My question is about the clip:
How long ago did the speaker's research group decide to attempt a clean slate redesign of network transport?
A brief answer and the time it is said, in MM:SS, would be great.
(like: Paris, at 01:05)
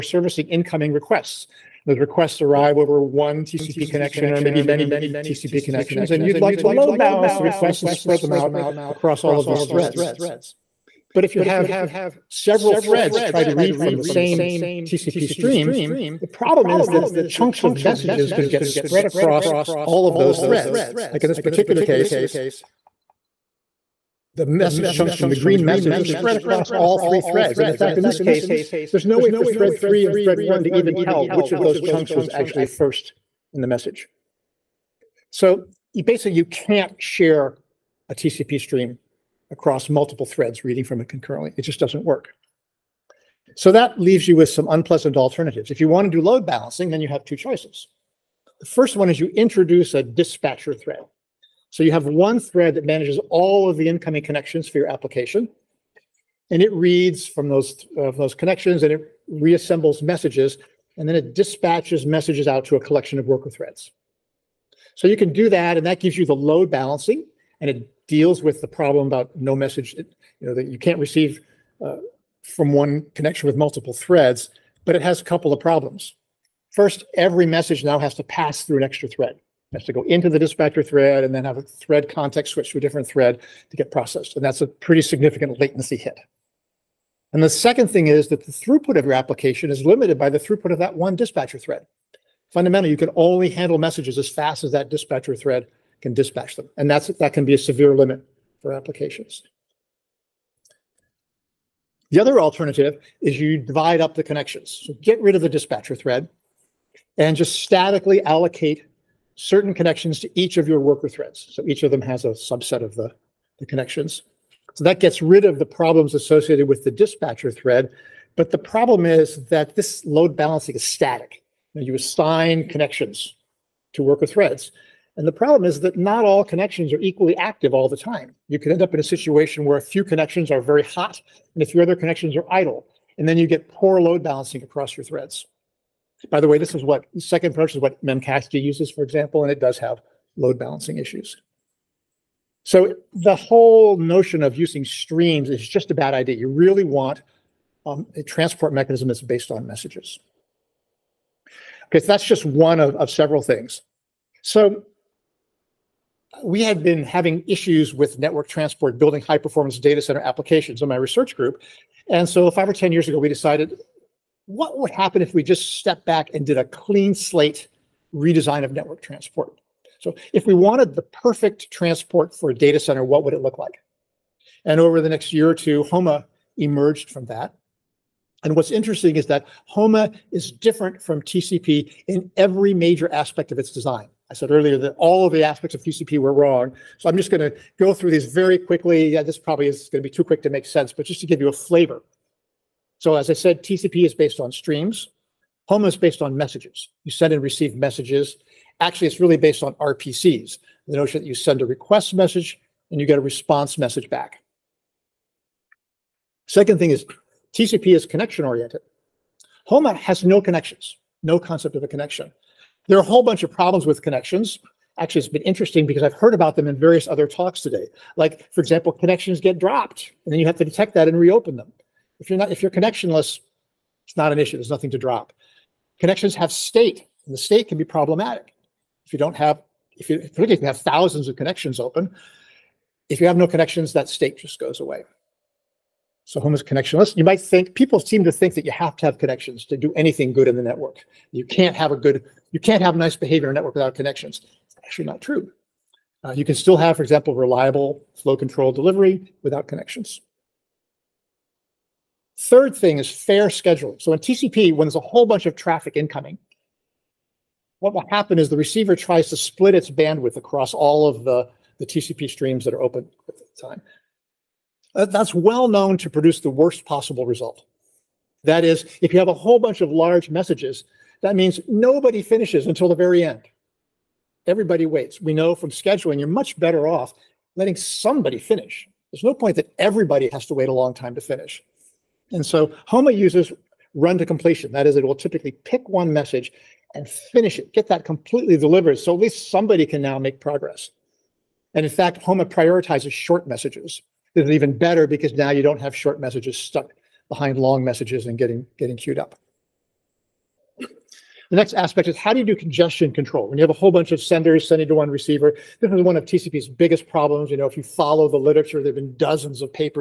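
5 or 10 years, at 02:42.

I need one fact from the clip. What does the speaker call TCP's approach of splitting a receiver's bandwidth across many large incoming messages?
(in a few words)
fair scheduling.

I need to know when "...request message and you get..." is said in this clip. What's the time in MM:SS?
03:21.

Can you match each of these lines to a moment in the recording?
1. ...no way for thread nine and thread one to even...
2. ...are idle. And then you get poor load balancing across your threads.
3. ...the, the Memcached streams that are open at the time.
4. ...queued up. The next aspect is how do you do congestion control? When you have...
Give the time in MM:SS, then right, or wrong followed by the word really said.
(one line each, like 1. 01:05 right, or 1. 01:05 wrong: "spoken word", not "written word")
1. 00:29 wrong: "three", not "nine"
2. 02:12 right
3. 04:21 wrong: "TCP", not "Memcached"
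4. 04:58 right.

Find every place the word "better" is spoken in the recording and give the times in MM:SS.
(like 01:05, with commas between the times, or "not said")
04:36, 04:54.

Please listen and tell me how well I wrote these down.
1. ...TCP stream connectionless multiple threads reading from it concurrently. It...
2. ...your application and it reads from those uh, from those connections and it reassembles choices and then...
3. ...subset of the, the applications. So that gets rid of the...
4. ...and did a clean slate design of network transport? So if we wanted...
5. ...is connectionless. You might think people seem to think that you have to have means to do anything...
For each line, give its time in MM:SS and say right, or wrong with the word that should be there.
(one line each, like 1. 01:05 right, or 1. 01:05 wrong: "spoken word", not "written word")
1. 00:38 wrong: "across", not "connectionless"
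2. 00:54 wrong: "messages", not "choices"
3. 01:52 wrong: "connections", not "applications"
4. 02:46 wrong: "redesign", not "design"
5. 03:56 wrong: "connections", not "means".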